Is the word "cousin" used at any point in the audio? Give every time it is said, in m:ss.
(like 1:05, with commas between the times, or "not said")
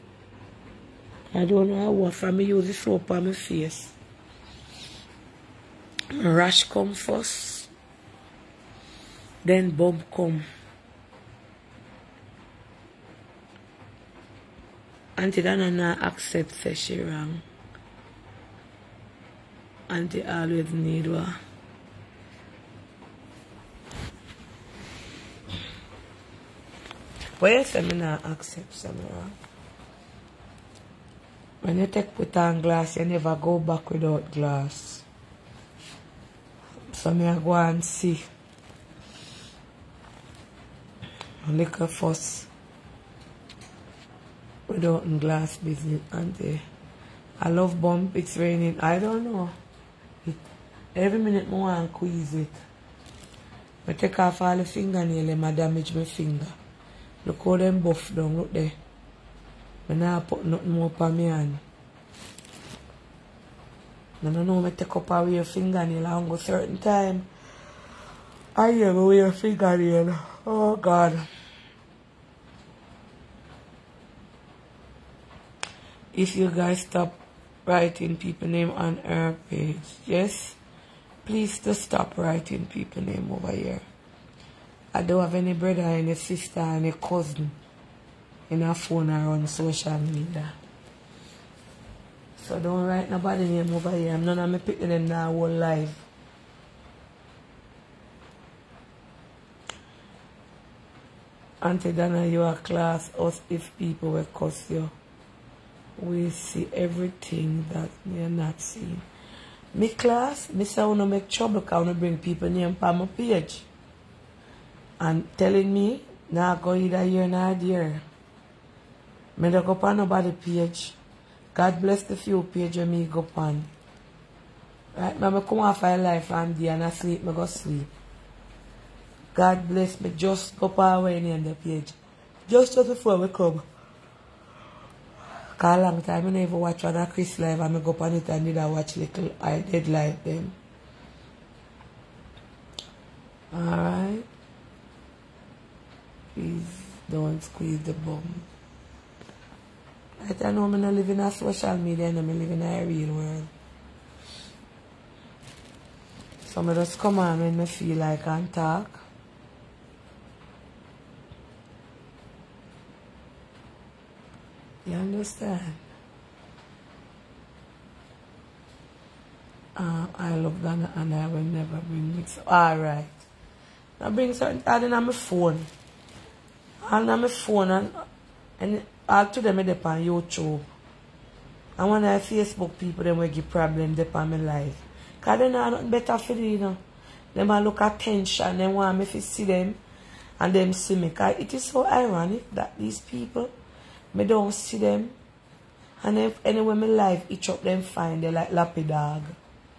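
1:26.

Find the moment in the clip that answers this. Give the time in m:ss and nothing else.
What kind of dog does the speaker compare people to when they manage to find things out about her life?
3:18.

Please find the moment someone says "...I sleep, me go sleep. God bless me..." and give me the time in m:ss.
2:06.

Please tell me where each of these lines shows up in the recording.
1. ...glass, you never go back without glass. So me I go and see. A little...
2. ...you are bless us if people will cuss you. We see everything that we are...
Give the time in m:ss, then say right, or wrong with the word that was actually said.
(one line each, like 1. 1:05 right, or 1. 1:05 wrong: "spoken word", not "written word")
1. 0:32 right
2. 1:42 wrong: "class", not "bless".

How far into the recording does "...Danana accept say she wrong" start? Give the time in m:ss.
0:15.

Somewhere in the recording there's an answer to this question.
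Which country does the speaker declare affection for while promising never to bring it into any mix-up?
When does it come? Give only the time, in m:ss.
2:50.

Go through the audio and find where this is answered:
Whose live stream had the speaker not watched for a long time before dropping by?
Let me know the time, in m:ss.
2:17.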